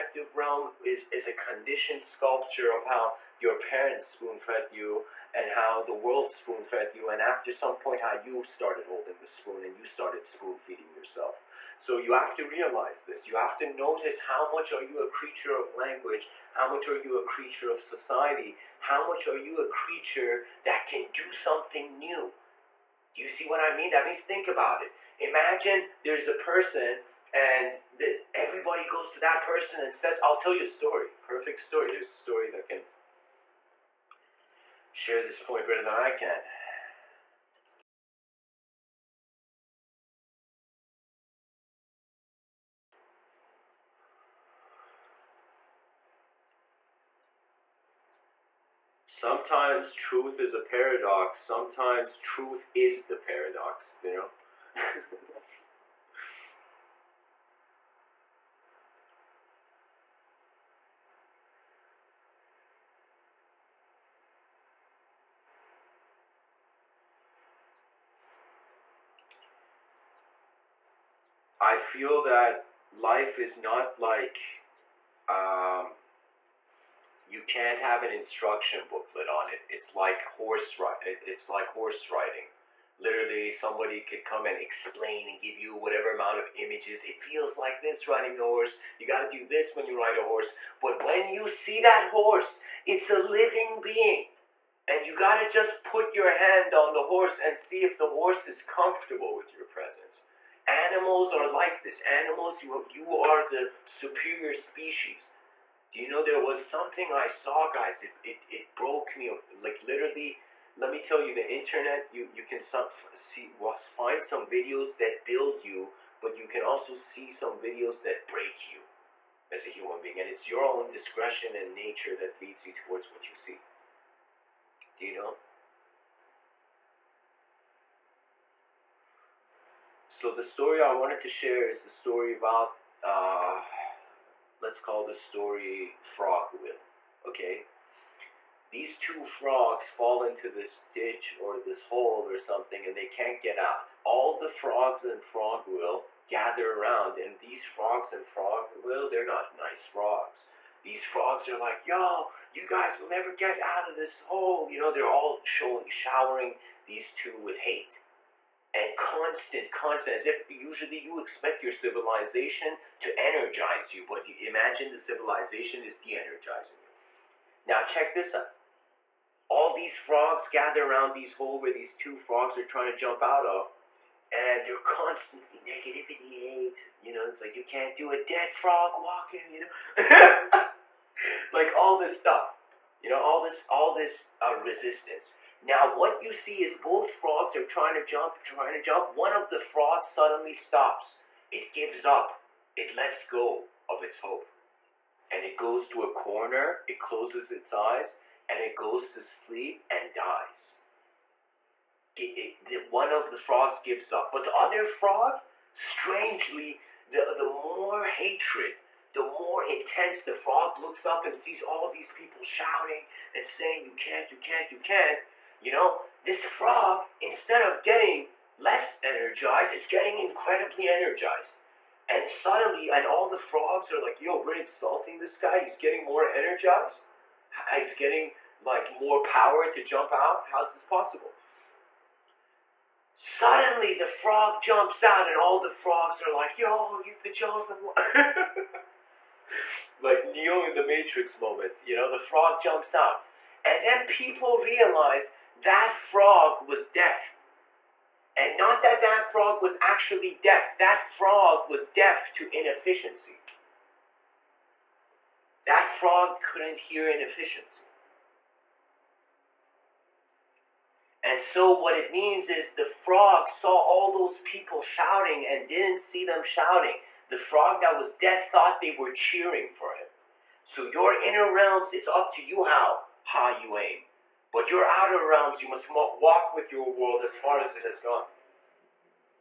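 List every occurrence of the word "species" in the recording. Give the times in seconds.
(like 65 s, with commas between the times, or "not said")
104 s.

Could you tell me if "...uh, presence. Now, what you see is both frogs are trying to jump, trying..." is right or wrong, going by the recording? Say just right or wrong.
wrong.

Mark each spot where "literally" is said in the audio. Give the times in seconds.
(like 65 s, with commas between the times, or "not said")
82 s, 109 s.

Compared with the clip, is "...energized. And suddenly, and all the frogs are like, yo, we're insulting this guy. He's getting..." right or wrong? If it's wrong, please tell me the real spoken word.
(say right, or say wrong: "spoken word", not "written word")
right.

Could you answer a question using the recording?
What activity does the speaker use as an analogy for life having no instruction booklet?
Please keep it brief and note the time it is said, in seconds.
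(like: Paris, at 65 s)
Horse riding, at 81 s.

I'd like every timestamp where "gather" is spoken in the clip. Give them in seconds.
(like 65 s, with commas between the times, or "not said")
146 s, 170 s.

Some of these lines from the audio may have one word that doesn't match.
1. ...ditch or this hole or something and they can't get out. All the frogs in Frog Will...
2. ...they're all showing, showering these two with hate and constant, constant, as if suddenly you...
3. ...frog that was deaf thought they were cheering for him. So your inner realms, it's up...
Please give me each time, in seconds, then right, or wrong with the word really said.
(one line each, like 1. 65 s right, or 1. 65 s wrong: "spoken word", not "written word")
1. 140 s right
2. 154 s wrong: "usually", not "suddenly"
3. 267 s right.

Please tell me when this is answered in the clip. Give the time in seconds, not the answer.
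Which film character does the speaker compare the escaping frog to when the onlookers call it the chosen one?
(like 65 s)
240 s.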